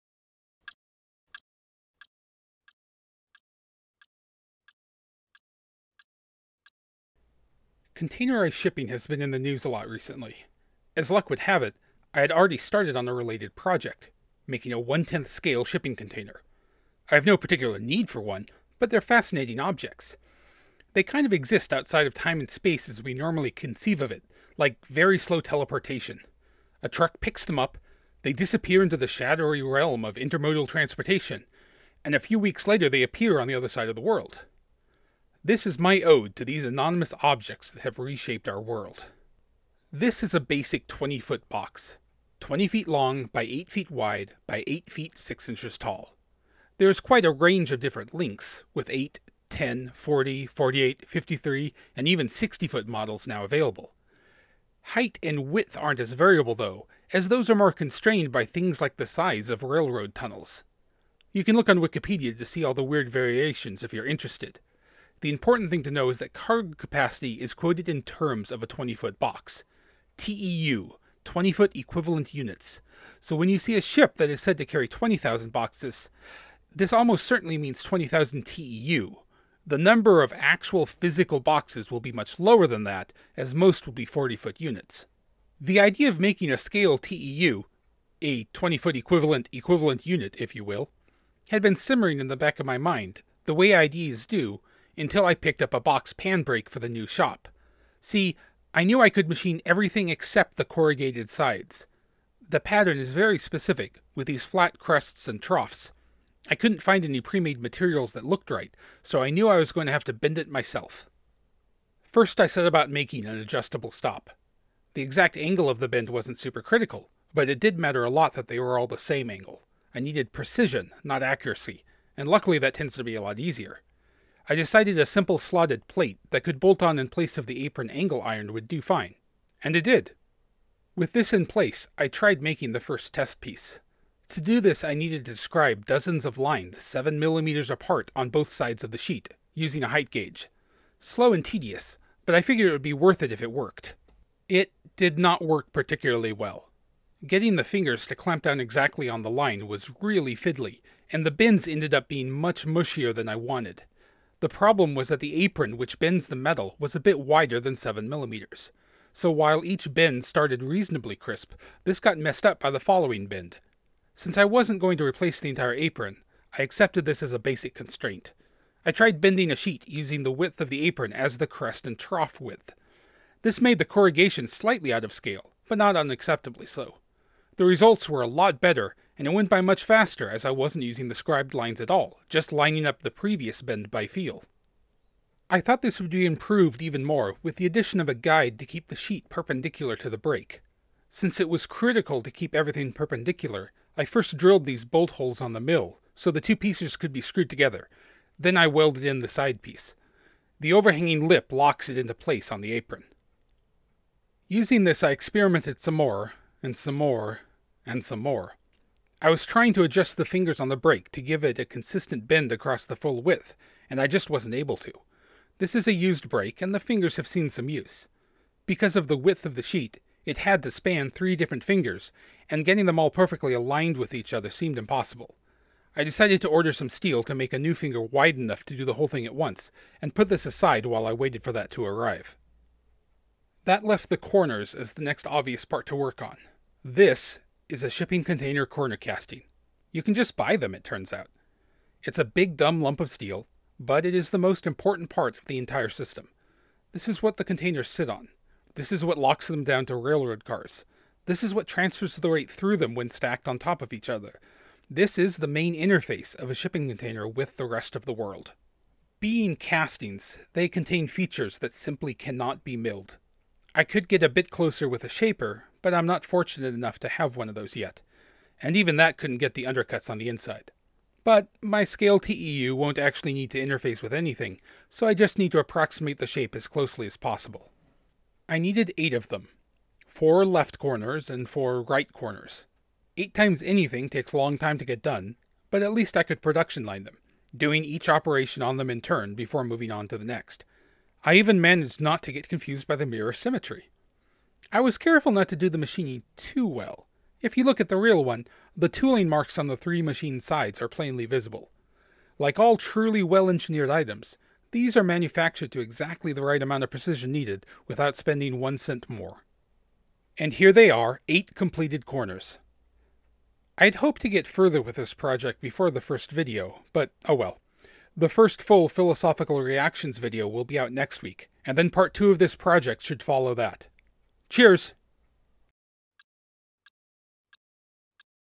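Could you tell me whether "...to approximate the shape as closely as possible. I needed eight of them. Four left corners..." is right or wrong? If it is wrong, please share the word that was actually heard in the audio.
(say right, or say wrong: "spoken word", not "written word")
right.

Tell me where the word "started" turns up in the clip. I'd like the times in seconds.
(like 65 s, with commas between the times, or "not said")
12 s, 160 s.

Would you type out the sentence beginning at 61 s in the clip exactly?
You can look on Wikipedia to see all the weird variations if you're interested.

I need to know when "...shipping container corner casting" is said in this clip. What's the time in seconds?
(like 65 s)
237 s.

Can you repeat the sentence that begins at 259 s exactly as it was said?
Being castings, they contain features that simply cannot be milled.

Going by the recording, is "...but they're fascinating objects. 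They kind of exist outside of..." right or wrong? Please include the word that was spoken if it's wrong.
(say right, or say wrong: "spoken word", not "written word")
right.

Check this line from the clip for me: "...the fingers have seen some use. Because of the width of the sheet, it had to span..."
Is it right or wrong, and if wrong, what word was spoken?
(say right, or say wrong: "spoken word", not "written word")
right.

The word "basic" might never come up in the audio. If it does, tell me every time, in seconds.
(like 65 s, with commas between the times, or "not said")
40 s, 167 s.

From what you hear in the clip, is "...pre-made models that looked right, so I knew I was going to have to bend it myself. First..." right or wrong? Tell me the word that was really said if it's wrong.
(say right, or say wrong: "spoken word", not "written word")
wrong: "materials", not "models".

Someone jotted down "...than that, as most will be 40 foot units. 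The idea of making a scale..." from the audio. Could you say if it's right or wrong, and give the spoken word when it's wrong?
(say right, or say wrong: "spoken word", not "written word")
right.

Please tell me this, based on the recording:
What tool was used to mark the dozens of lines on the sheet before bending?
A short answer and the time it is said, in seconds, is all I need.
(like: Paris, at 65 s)
Height gauge, at 139 s.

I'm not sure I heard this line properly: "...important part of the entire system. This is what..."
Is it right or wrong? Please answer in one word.
right.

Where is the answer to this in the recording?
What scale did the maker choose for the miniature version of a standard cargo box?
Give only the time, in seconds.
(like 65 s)
14 s.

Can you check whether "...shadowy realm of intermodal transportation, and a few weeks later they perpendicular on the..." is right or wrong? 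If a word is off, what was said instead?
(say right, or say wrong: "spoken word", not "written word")
wrong: "appear", not "perpendicular".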